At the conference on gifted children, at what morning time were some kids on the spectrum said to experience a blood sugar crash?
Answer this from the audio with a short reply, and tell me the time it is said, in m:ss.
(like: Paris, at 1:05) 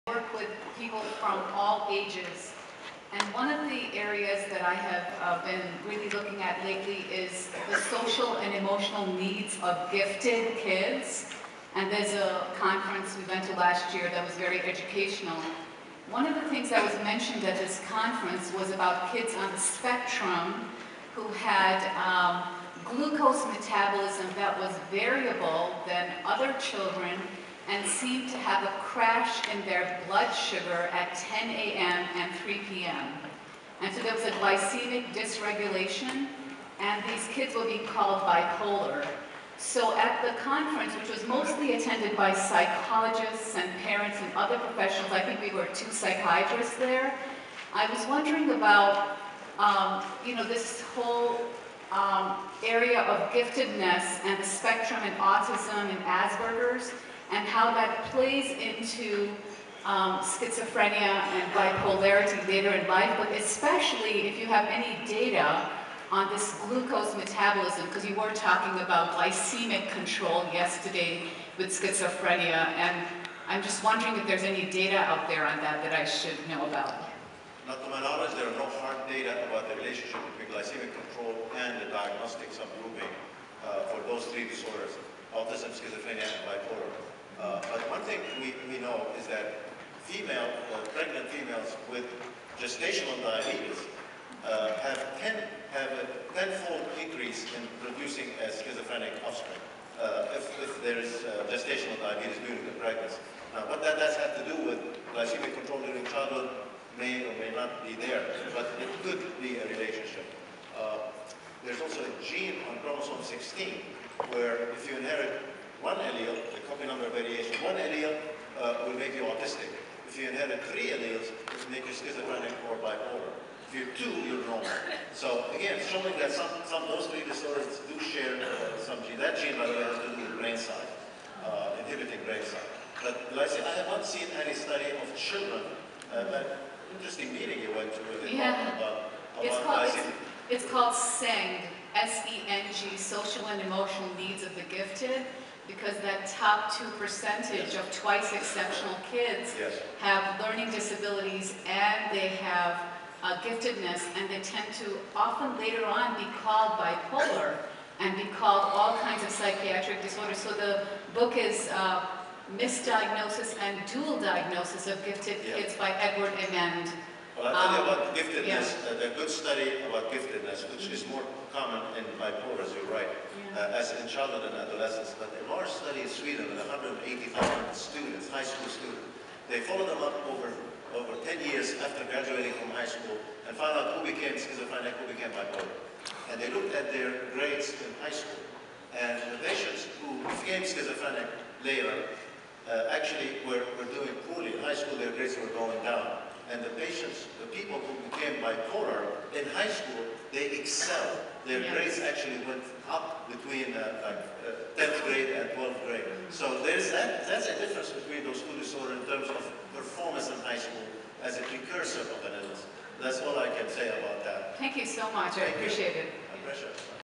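10 a.m., at 0:31.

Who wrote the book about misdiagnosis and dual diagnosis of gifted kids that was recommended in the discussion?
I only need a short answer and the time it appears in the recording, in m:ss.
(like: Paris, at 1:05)
Edward Amend, at 2:45.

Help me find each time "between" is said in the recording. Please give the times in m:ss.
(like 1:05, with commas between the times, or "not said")
1:20, 3:23, 3:27.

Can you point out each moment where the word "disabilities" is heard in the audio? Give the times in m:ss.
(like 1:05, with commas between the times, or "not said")
2:30.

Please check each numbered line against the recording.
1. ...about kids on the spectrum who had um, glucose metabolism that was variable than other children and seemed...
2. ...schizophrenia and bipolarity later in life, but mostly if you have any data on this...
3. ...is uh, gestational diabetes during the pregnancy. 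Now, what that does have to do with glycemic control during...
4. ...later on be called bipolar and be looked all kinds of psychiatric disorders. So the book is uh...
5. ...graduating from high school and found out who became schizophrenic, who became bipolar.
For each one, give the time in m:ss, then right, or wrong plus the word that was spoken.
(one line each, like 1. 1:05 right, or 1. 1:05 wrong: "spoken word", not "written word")
1. 0:18 right
2. 1:00 wrong: "especially", not "mostly"
3. 1:41 right
4. 2:35 wrong: "called", not "looked"
5. 3:02 right.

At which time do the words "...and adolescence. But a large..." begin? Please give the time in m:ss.
2:54.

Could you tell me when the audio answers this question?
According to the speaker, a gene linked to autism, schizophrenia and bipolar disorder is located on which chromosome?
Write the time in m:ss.
1:52.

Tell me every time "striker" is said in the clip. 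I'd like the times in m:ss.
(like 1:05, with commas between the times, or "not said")
not said.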